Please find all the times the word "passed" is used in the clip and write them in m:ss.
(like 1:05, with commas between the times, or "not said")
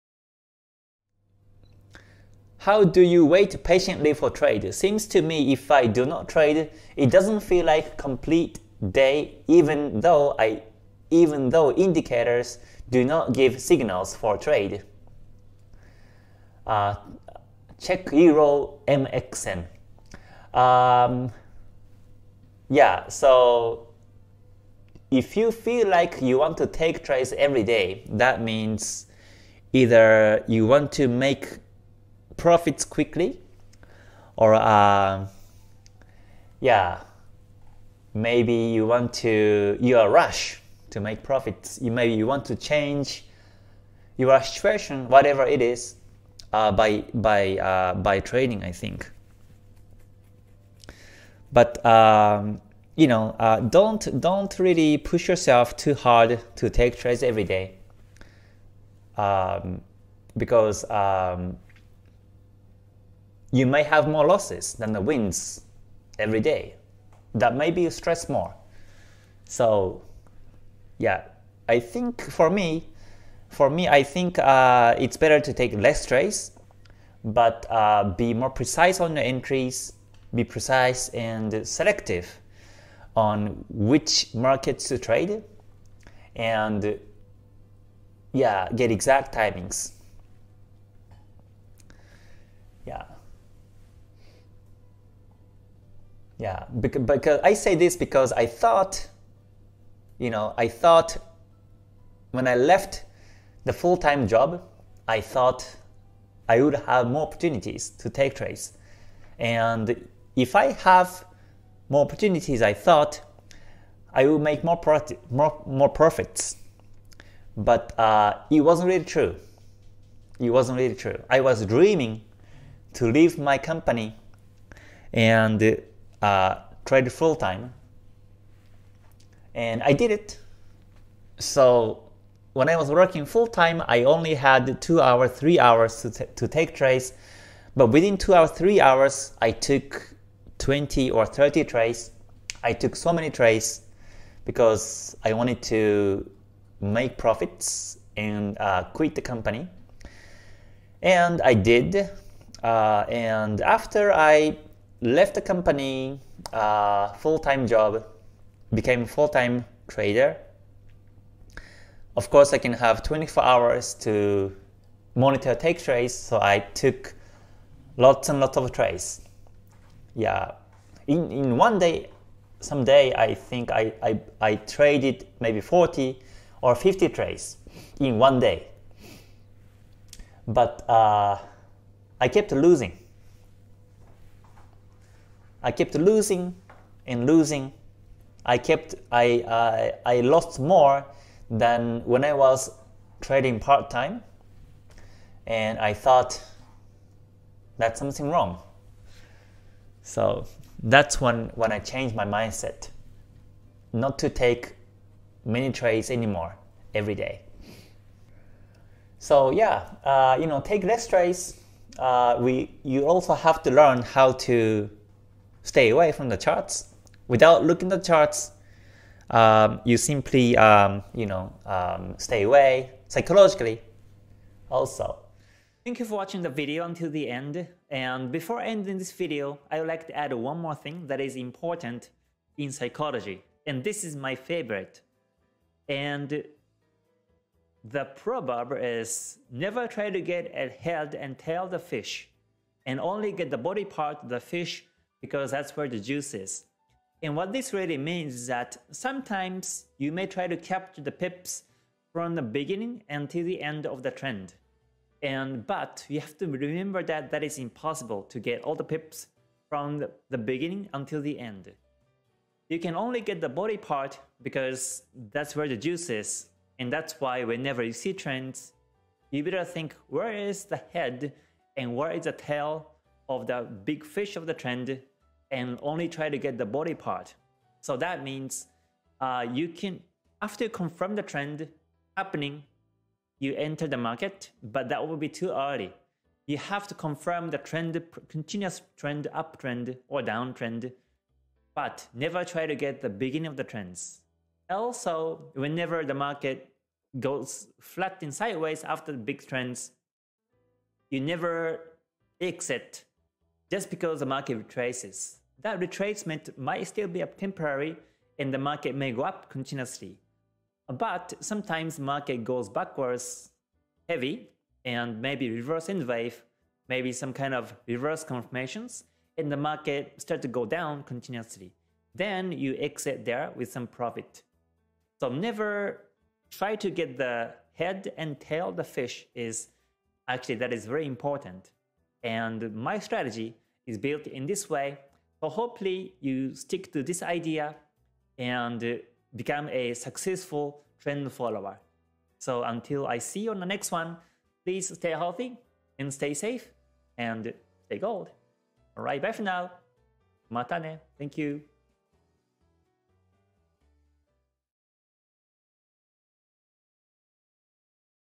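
not said.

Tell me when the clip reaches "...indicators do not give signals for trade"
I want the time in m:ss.
0:11.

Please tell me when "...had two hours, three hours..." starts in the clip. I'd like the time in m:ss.
2:14.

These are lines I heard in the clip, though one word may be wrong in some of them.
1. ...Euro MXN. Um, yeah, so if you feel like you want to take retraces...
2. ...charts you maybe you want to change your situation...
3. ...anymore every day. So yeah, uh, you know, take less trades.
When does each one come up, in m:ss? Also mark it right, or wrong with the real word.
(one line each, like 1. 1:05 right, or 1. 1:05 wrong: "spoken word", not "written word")
1. 0:18 wrong: "trades", not "retraces"
2. 0:41 wrong: "profits", not "charts"
3. 3:26 right.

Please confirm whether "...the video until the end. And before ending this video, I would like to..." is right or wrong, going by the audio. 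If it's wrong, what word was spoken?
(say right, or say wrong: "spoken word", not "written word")
right.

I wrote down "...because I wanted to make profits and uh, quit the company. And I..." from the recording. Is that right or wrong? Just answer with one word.
right.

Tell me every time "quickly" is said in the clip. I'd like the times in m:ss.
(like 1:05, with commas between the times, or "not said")
0:32.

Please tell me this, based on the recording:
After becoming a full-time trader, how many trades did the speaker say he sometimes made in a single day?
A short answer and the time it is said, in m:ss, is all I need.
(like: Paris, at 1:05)
40 or 50, at 2:55.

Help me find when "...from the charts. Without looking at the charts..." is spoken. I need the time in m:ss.
3:36.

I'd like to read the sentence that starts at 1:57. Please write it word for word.
But uh, it wasn't really true.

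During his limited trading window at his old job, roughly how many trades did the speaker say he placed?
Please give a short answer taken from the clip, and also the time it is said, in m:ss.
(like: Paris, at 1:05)
20 or 30, at 2:20.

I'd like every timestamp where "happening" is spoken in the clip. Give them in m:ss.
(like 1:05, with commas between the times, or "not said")
4:42.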